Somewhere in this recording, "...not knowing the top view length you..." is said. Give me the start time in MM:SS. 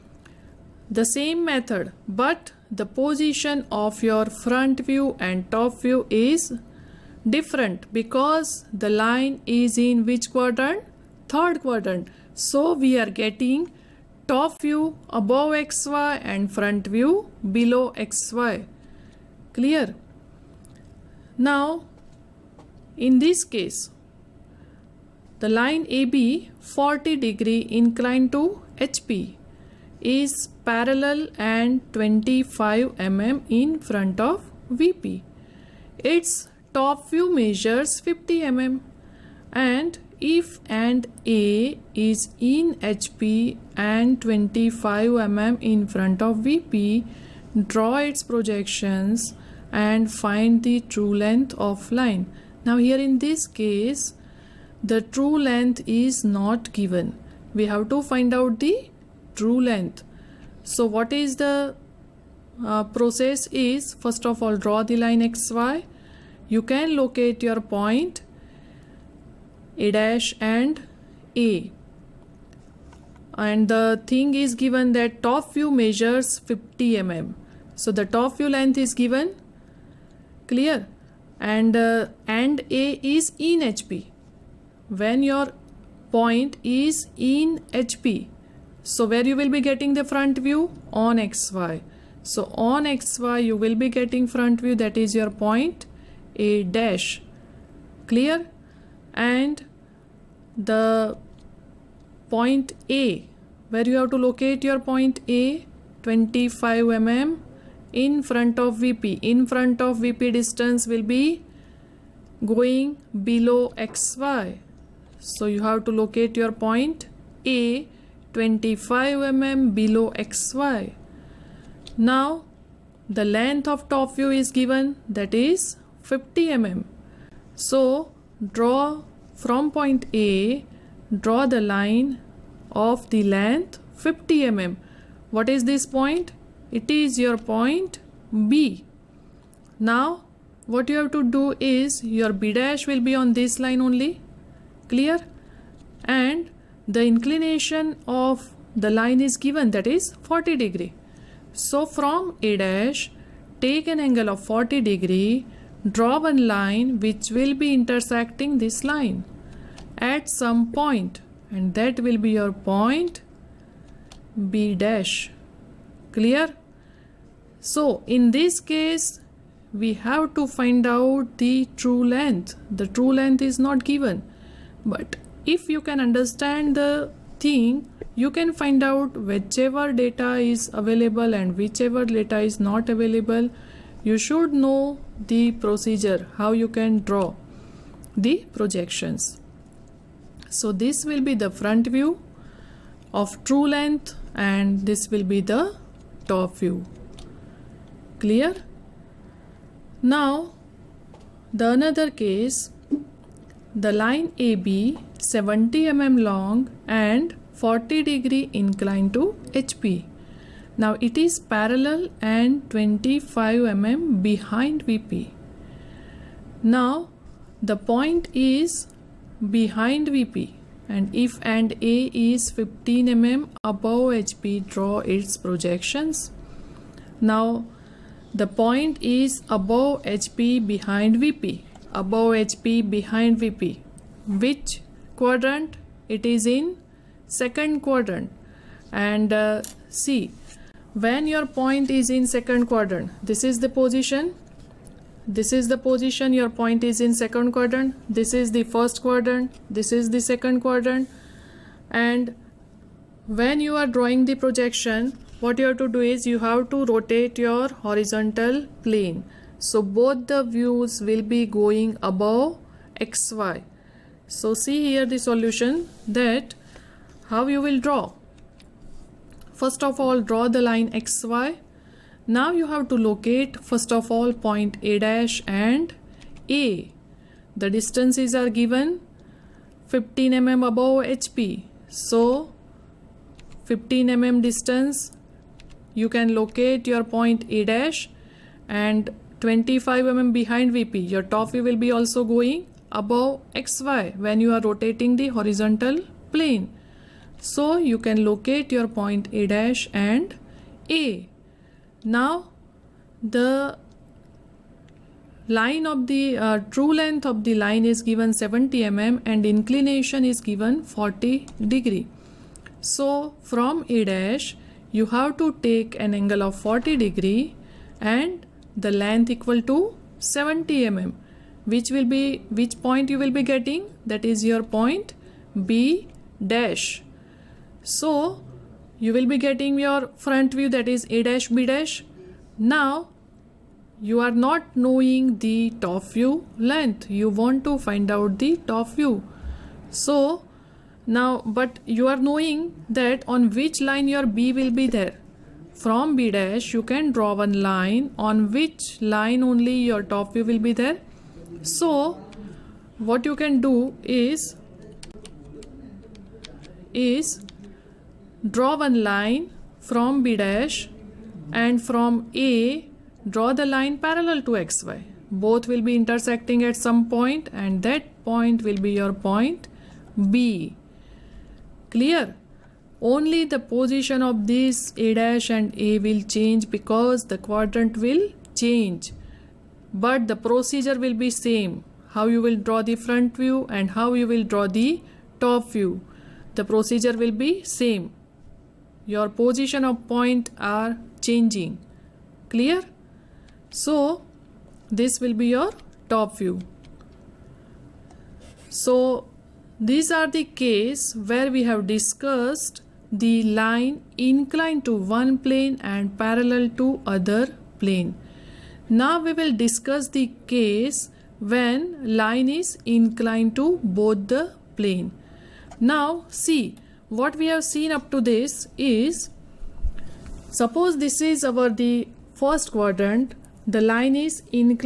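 05:34.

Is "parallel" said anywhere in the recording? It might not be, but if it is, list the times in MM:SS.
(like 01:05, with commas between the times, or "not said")
00:30, 03:31, 06:03, 06:46.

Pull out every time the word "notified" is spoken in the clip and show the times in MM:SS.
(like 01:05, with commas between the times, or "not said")
not said.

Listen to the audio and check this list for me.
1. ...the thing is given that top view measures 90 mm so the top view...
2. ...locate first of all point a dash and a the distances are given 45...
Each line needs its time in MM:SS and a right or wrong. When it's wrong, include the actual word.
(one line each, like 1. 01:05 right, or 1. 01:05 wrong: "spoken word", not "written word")
1. 01:13 wrong: "50", not "90"
2. 04:33 wrong: "15", not "45".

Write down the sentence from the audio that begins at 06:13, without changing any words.
Only the position of this A dash and A will change because the quadrant will change.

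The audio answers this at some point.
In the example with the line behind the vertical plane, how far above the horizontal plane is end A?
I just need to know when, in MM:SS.
03:41.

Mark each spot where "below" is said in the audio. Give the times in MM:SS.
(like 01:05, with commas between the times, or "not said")
00:17, 01:53, 01:59.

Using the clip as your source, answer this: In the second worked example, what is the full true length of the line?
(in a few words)
70 mm.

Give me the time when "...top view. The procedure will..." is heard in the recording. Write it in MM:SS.
06:25.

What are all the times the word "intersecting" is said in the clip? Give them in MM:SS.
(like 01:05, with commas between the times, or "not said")
02:37, 06:05.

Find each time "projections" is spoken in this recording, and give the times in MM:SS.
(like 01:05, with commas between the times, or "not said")
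00:48, 03:08, 03:45, 04:14.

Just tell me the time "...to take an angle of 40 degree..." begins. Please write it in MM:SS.
05:15.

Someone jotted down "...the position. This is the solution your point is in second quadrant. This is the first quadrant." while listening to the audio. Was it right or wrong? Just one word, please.
wrong.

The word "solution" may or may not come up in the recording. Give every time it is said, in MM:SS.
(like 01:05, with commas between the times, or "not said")
04:25.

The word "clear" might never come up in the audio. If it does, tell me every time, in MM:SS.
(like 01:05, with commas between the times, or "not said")
00:19, 01:20, 01:38, 02:24, 02:46, 03:18, 06:11, 06:32.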